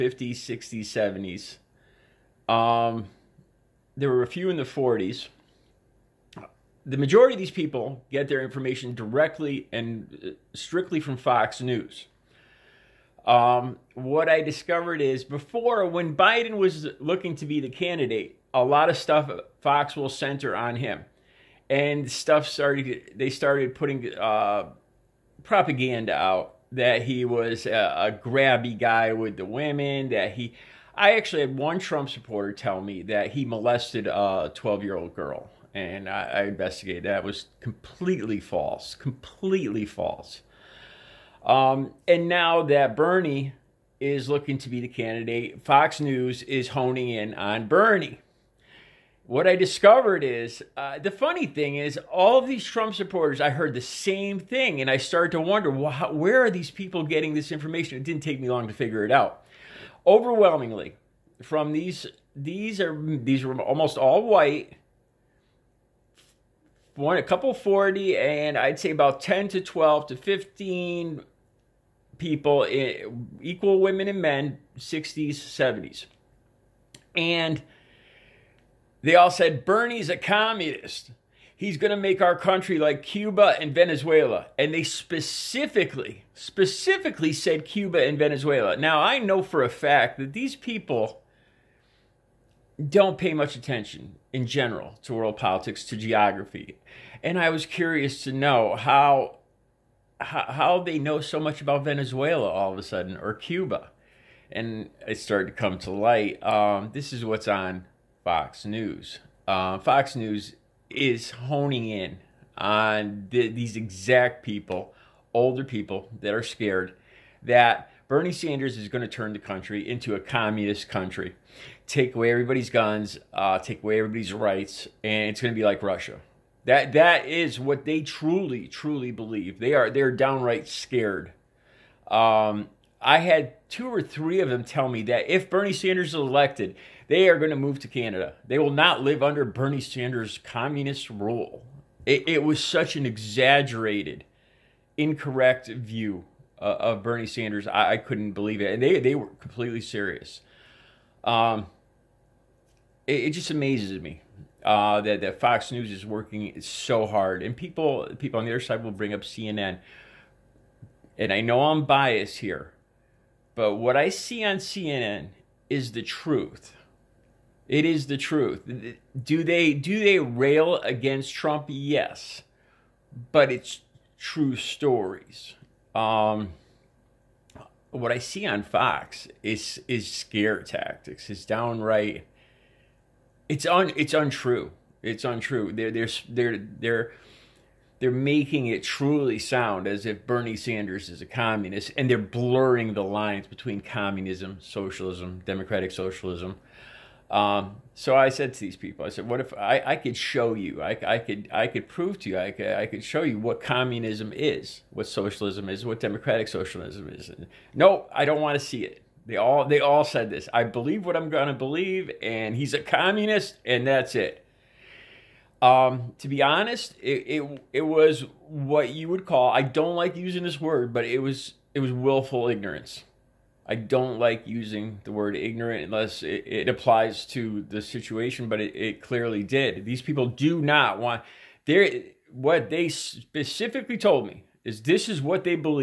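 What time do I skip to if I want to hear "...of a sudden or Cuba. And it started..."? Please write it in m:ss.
1:42.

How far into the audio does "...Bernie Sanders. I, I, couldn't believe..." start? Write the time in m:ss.
2:27.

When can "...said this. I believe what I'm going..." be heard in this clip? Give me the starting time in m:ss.
3:30.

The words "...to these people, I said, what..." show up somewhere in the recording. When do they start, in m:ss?
3:18.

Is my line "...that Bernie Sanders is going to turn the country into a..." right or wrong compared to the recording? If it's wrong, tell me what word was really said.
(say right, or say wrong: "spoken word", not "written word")
right.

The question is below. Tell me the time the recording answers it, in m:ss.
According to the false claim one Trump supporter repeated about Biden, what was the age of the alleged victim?
0:34.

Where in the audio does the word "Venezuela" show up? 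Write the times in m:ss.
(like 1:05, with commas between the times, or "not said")
1:23, 1:28, 1:41.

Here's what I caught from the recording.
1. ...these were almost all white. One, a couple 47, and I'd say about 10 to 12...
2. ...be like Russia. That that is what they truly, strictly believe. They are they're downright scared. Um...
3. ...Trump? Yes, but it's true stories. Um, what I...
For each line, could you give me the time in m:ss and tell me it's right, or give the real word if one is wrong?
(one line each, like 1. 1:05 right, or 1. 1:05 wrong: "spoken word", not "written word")
1. 1:03 wrong: "40", not "47"
2. 2:05 wrong: "truly", not "strictly"
3. 2:51 right.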